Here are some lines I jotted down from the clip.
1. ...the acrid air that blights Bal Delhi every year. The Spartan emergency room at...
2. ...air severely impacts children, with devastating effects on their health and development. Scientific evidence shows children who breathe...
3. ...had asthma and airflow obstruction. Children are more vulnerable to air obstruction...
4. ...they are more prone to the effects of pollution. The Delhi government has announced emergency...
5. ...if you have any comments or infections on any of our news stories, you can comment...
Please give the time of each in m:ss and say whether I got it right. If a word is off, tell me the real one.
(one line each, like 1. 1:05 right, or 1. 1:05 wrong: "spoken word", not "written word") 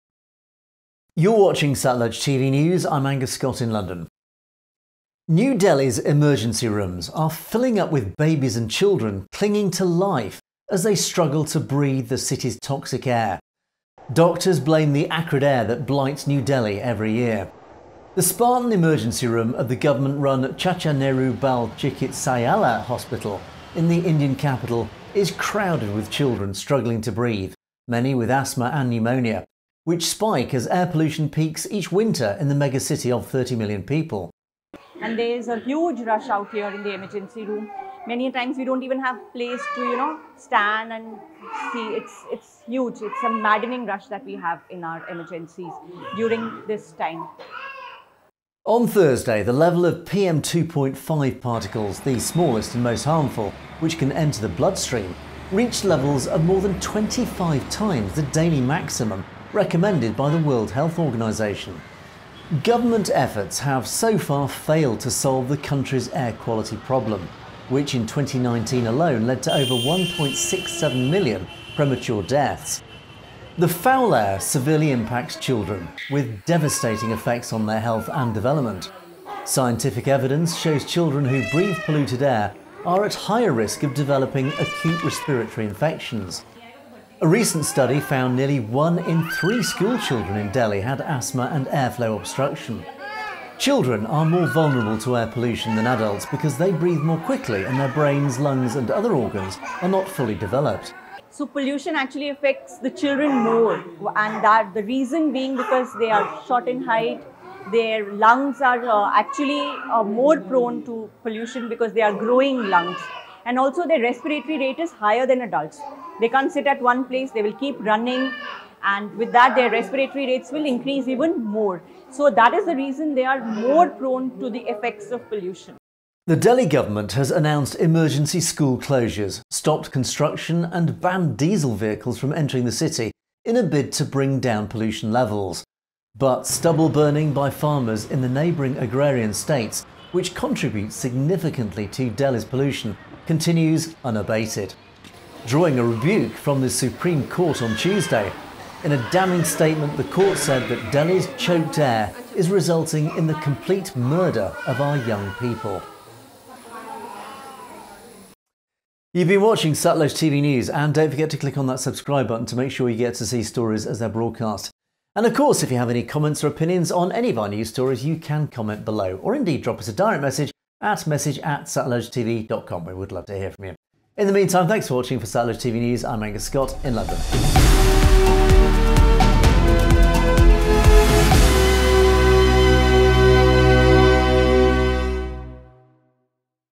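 1. 0:14 wrong: "New", not "Bal"
2. 1:14 right
3. 1:30 wrong: "pollution", not "obstruction"
4. 2:03 right
5. 2:45 wrong: "opinions", not "infections".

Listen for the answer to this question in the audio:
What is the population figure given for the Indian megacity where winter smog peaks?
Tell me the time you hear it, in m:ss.
0:33.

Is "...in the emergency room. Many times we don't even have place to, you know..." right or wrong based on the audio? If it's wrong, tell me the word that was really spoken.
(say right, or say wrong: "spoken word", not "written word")
right.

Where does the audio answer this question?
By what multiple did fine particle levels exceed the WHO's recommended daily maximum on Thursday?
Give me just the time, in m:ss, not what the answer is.
0:56.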